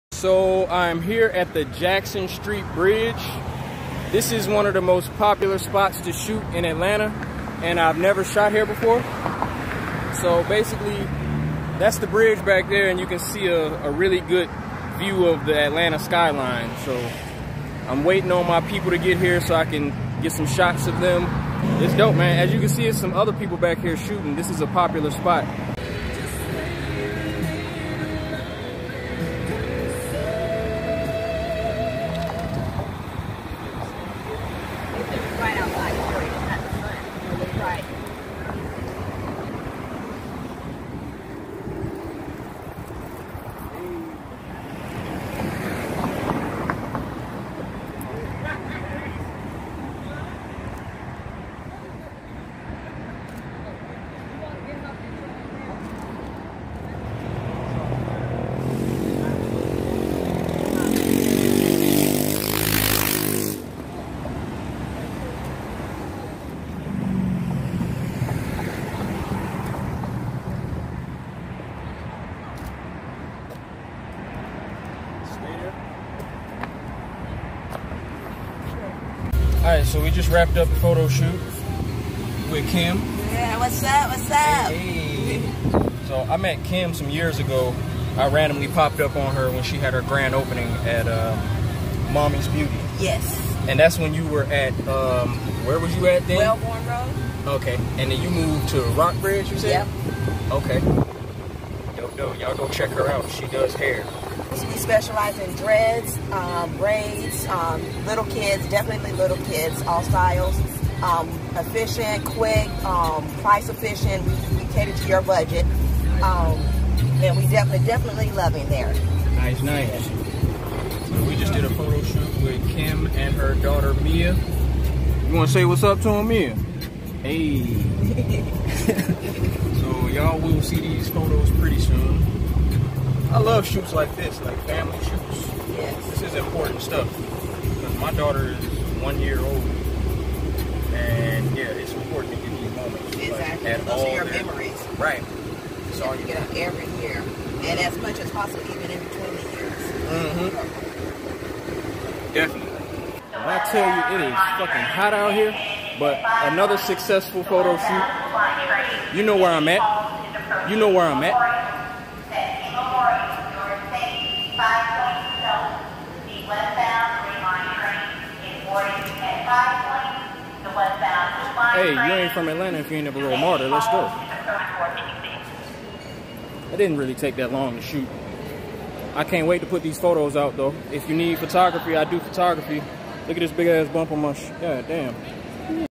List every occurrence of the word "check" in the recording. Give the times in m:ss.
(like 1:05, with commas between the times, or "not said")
1:42.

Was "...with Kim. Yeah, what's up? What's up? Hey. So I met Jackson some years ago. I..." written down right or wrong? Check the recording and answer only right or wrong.
wrong.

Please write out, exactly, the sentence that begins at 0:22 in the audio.
As you can see, it's some other people back here shooting.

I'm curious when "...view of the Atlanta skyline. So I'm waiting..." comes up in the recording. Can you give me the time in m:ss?
0:14.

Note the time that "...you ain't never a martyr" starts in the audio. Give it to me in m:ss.
2:52.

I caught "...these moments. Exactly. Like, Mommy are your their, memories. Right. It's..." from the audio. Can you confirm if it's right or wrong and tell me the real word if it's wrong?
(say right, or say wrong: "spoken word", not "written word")
wrong: "Those", not "Mommy".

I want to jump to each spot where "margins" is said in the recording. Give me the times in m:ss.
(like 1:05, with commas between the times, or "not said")
not said.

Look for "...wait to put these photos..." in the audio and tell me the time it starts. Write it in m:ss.
2:59.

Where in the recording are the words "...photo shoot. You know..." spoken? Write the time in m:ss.
2:37.